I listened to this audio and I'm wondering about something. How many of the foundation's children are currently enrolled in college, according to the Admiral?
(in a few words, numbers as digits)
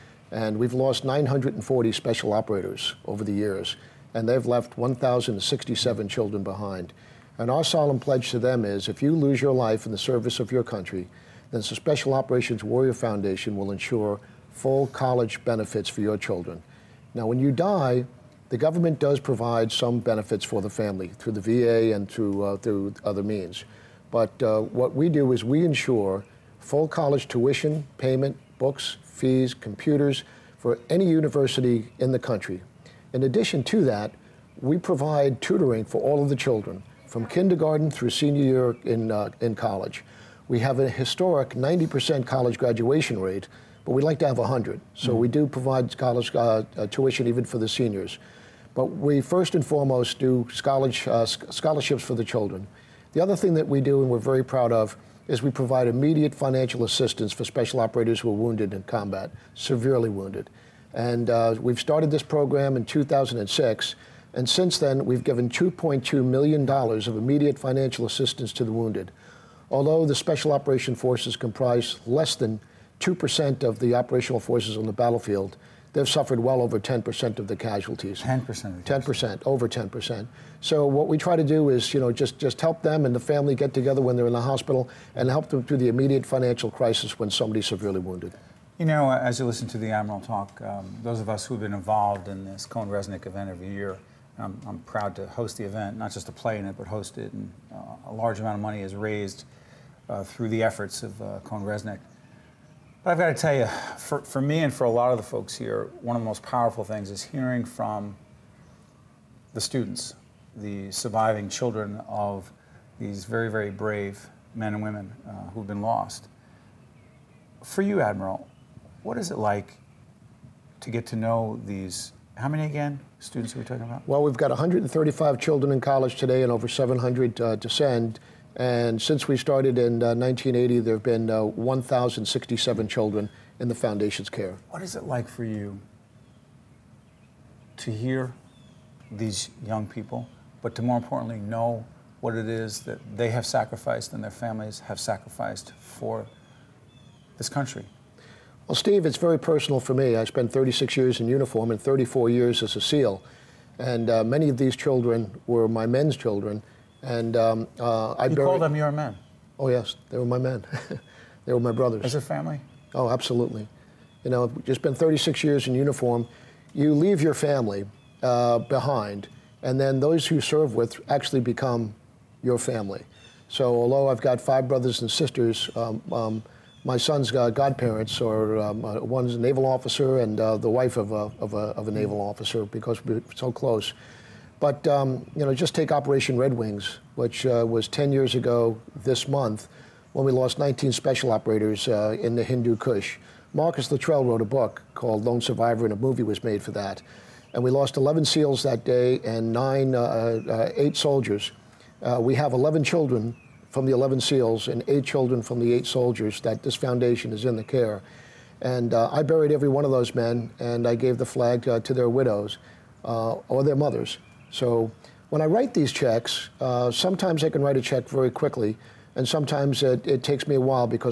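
135.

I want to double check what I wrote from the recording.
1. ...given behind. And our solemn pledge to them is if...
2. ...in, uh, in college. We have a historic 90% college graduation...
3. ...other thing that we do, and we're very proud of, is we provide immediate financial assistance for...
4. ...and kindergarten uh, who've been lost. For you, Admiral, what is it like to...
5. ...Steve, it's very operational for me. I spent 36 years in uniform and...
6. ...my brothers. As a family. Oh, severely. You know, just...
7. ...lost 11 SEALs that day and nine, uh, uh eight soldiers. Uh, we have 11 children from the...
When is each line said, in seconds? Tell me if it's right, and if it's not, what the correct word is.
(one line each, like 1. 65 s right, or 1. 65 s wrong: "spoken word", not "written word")
1. 6 s wrong: "children", not "given"
2. 38 s right
3. 53 s right
4. 114 s wrong: "women", not "kindergarten"
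5. 148 s wrong: "personal", not "operational"
6. 161 s wrong: "absolutely", not "severely"
7. 197 s right.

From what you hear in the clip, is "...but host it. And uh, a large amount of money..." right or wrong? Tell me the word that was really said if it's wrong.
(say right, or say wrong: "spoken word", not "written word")
right.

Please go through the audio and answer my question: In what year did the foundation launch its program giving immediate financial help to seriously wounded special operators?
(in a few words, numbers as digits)
2006.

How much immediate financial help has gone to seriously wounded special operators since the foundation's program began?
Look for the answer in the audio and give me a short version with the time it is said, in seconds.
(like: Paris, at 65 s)
$2.2 million, at 65 s.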